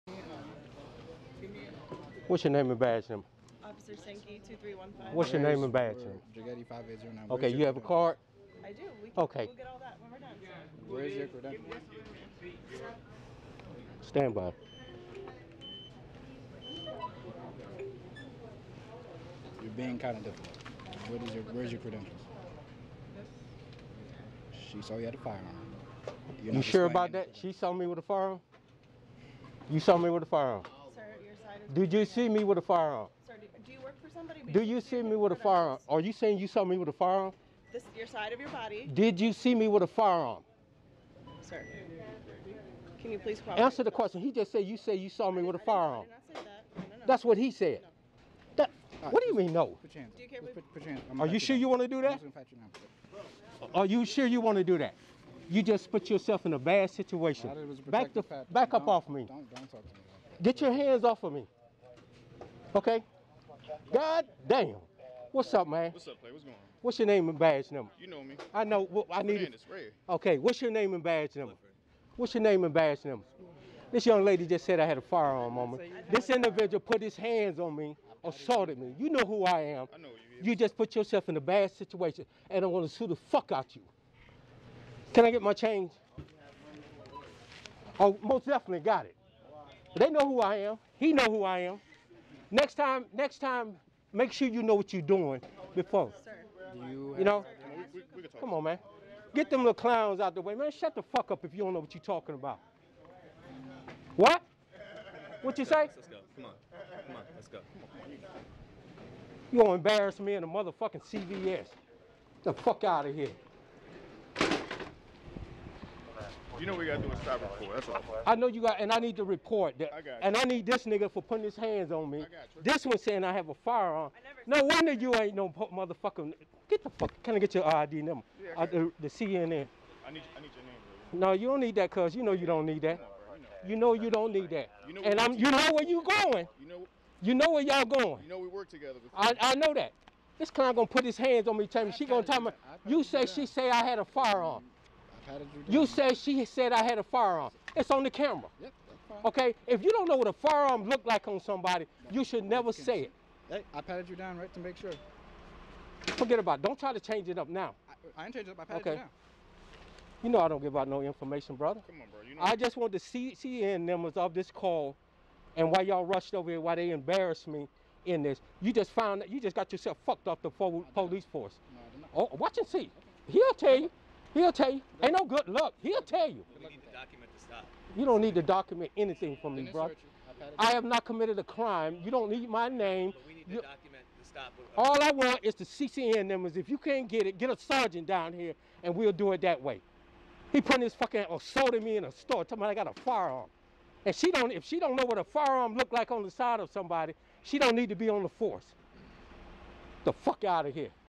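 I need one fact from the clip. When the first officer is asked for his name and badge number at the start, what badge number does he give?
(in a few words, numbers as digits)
2315.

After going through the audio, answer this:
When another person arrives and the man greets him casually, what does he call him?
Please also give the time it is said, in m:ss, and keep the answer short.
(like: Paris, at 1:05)
Clay, at 1:06.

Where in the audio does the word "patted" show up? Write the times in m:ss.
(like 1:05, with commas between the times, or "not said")
2:33, 2:38.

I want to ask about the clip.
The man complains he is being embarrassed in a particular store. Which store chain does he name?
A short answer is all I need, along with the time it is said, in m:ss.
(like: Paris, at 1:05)
CVS, at 1:51.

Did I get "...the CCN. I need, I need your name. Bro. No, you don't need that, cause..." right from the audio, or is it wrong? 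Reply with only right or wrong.
right.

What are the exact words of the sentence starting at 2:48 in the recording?
You just found that you just got yourself fucked off the police force.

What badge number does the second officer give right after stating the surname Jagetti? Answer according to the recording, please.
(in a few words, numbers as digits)
5809.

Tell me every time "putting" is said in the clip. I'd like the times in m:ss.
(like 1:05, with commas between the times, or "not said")
2:01, 3:10.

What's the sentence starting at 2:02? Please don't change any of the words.
This one saying I have a firearm.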